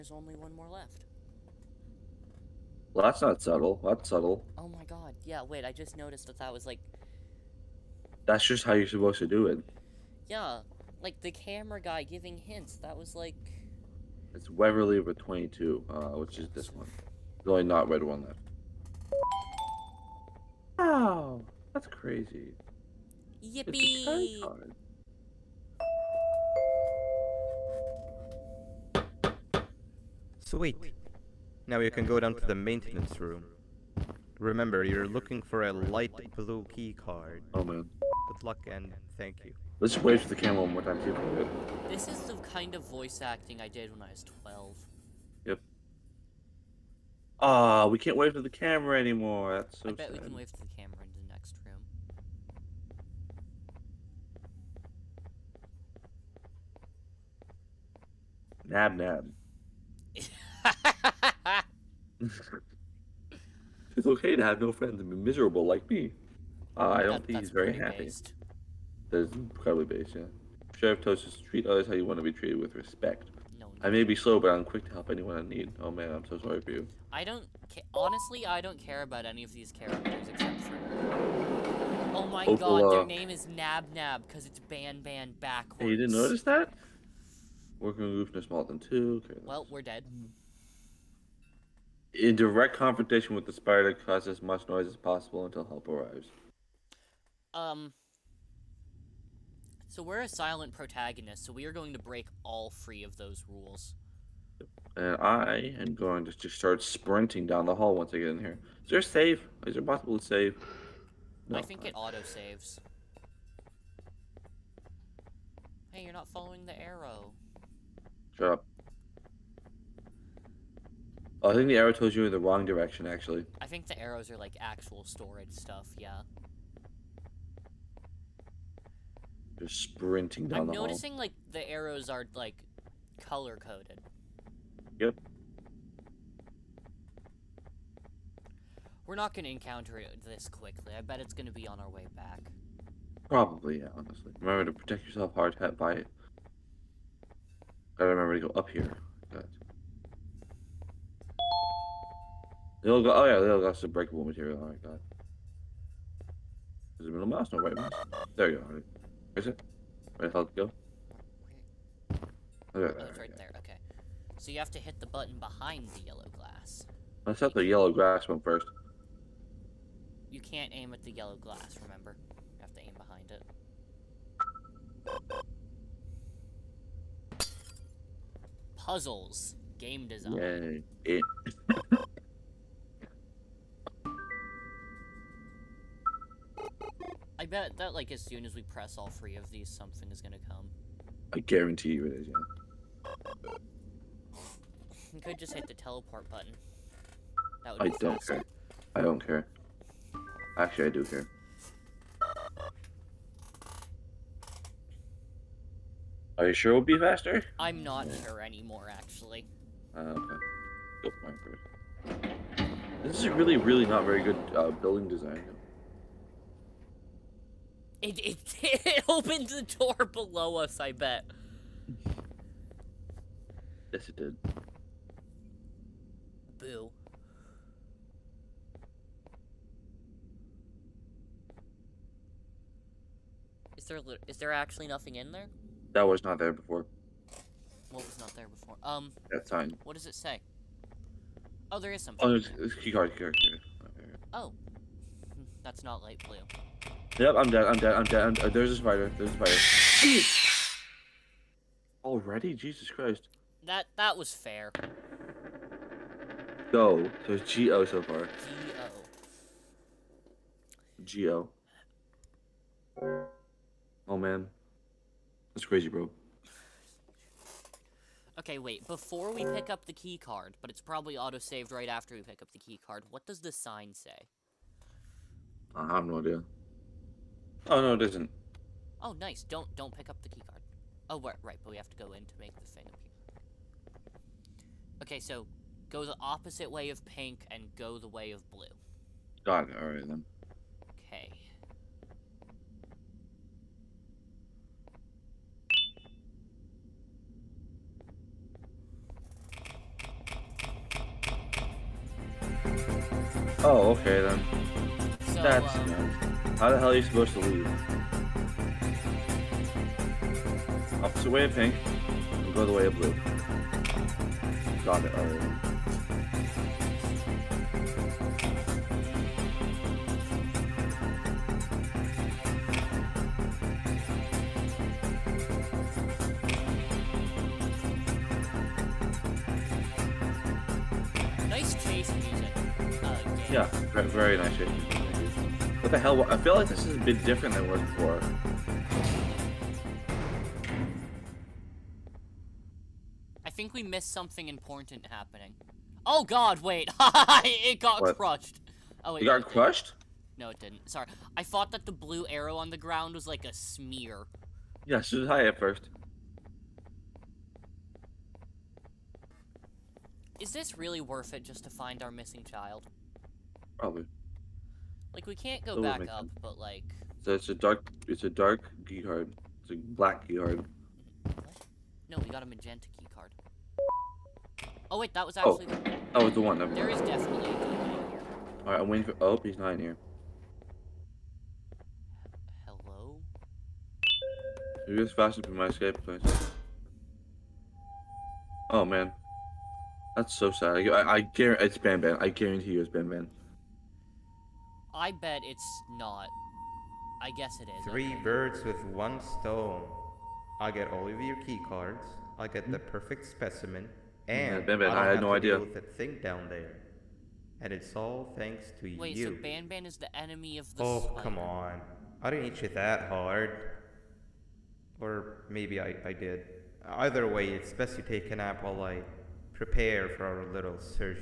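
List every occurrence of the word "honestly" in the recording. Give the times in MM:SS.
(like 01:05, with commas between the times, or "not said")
01:17, 02:23.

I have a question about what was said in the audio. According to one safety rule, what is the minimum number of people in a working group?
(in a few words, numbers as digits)
2.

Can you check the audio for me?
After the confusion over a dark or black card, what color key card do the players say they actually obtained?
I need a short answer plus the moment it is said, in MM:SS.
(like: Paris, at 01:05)
magenta, at 06:12.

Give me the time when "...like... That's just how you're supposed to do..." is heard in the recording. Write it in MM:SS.
00:06.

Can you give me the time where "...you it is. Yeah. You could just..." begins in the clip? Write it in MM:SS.
03:11.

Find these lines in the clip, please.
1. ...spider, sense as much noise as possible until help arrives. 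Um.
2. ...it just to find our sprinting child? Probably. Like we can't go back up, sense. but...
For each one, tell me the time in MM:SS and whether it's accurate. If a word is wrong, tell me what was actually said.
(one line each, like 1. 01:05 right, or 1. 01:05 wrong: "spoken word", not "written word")
1. 01:33 wrong: "cause", not "sense"
2. 06:01 wrong: "missing", not "sprinting".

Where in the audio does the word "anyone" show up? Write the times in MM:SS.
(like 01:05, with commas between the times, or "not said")
01:15.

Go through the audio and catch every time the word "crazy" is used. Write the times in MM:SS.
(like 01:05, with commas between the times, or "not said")
00:21, 04:25.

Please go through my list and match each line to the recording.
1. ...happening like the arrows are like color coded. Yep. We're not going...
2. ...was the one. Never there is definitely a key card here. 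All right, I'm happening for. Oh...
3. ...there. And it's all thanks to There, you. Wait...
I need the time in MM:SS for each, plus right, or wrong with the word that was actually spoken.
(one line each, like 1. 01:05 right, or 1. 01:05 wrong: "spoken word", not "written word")
1. 02:10 wrong: "noticing", not "happening"
2. 06:16 wrong: "waiting", not "happening"
3. 06:46 wrong: "Wait", not "There".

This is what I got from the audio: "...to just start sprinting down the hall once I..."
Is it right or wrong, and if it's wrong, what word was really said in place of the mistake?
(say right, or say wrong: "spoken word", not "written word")
right.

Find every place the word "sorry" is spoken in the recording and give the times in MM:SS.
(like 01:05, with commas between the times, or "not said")
01:16, 05:50.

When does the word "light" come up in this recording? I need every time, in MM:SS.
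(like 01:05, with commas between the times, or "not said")
00:35, 04:06.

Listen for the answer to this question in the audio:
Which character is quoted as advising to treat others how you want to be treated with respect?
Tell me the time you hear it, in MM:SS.
01:10.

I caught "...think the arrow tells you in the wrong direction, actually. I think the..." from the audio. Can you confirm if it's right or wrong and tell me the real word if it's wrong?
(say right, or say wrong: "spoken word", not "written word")
right.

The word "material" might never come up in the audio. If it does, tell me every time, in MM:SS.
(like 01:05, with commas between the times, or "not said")
02:34.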